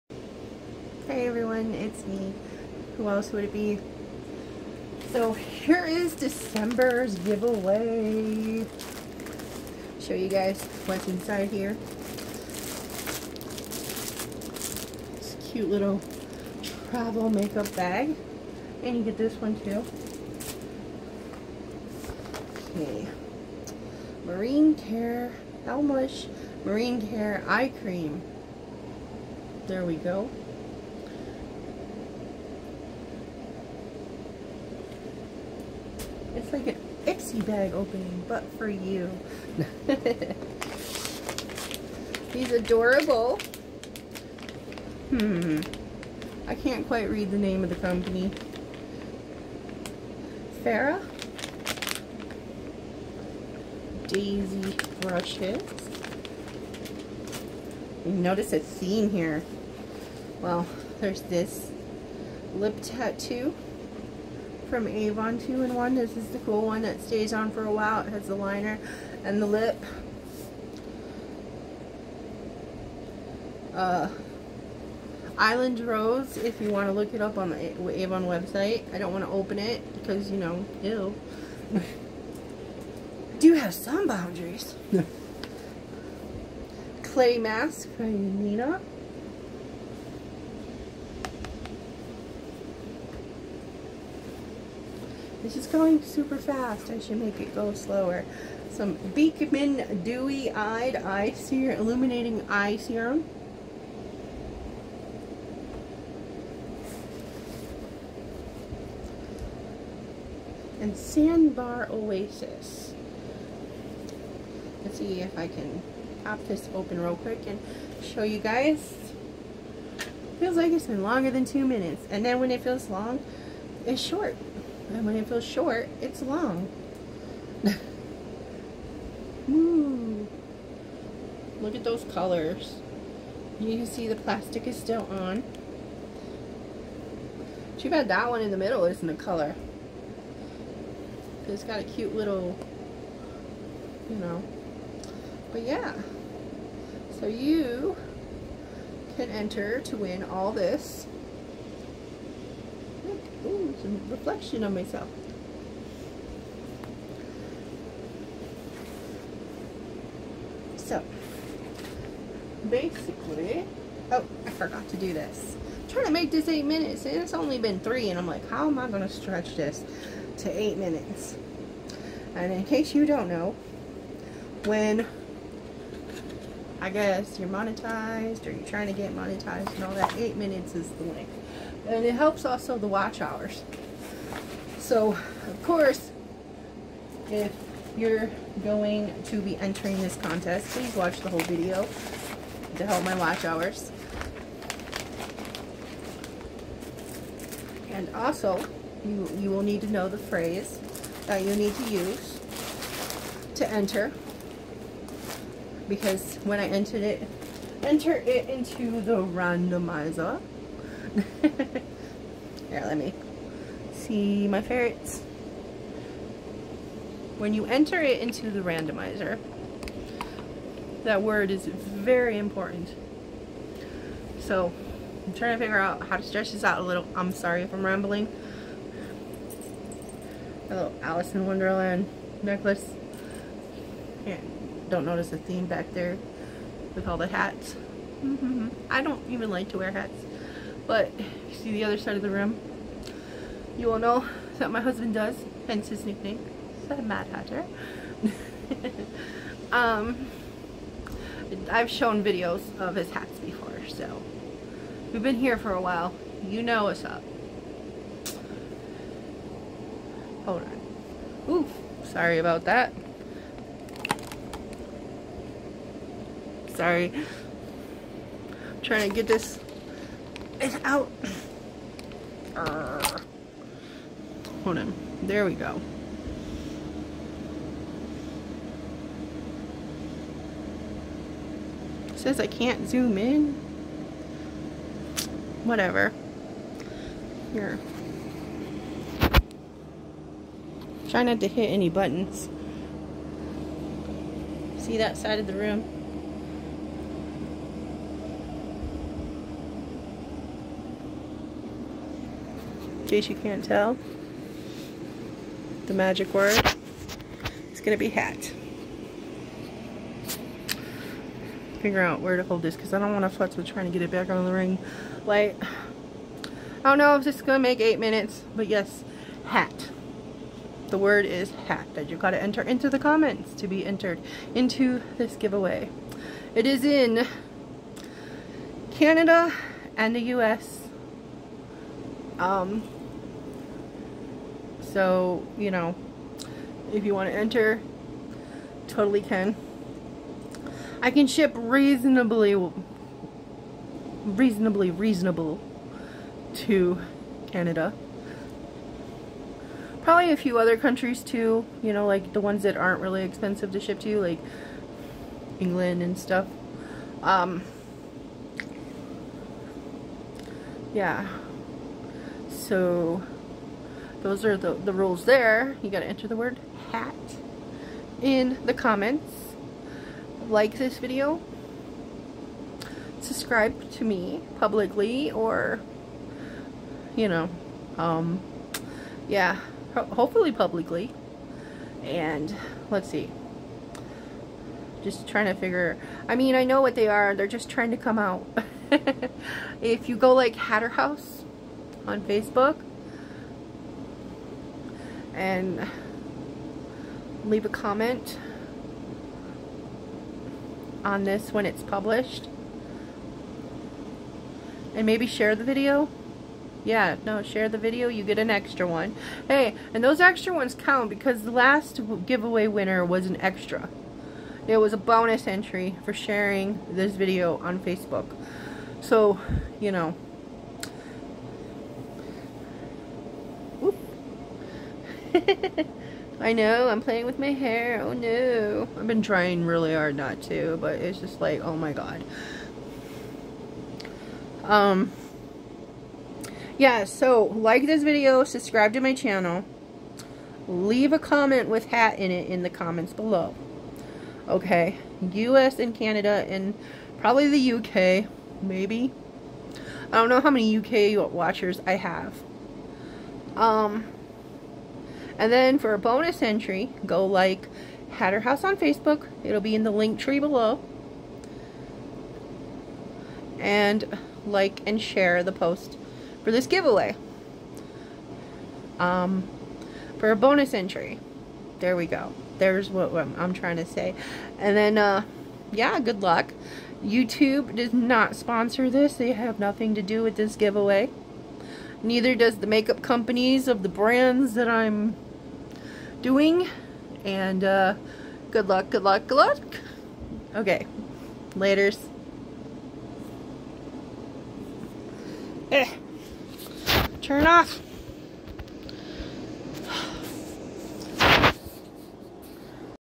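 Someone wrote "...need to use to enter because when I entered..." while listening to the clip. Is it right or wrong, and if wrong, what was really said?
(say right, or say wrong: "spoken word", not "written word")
right.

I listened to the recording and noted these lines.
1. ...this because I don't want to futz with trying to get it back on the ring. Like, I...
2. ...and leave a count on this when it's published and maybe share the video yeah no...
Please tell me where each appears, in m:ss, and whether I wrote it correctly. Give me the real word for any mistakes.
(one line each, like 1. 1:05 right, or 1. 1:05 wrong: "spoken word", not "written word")
1. 5:12 right
2. 6:35 wrong: "comment", not "count".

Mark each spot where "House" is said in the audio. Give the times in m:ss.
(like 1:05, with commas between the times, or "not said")
6:30, 7:38.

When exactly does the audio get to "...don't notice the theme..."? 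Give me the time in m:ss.
3:54.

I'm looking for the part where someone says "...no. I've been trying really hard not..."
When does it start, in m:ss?
7:08.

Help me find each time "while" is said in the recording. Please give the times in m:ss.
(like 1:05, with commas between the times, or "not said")
1:07, 4:15.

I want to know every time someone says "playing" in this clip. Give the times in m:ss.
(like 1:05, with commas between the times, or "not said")
7:07.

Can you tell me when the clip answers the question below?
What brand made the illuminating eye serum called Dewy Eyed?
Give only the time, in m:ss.
1:39.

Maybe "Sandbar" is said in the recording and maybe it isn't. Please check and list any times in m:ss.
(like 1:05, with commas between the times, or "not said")
1:50.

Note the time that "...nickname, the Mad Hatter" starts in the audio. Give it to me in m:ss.
4:06.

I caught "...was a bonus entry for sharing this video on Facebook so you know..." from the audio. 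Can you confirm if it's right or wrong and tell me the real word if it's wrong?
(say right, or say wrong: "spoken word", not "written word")
right.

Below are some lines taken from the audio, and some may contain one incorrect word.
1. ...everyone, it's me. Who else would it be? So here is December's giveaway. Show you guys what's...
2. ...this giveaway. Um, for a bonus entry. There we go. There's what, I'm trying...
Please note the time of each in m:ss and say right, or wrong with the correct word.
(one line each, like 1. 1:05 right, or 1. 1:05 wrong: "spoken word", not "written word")
1. 0:01 right
2. 7:46 right.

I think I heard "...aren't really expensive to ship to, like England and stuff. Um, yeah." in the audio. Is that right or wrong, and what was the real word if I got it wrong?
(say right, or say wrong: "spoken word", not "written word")
right.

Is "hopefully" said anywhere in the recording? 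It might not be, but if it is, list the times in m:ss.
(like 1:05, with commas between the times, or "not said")
6:20.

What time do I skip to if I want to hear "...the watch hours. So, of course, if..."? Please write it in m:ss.
3:02.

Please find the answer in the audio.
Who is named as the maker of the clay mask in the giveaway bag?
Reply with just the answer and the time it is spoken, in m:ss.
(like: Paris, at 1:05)
Nina, at 1:28.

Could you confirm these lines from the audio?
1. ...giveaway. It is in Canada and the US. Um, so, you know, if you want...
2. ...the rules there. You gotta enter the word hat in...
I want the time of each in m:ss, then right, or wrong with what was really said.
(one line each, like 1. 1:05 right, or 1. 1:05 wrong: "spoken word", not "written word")
1. 5:25 right
2. 6:04 right.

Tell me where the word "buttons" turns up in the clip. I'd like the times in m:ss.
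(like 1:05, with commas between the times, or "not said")
4:51.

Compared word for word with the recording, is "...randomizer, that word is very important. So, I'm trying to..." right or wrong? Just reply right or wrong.
right.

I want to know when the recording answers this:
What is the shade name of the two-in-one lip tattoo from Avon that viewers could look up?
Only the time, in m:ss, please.
1:15.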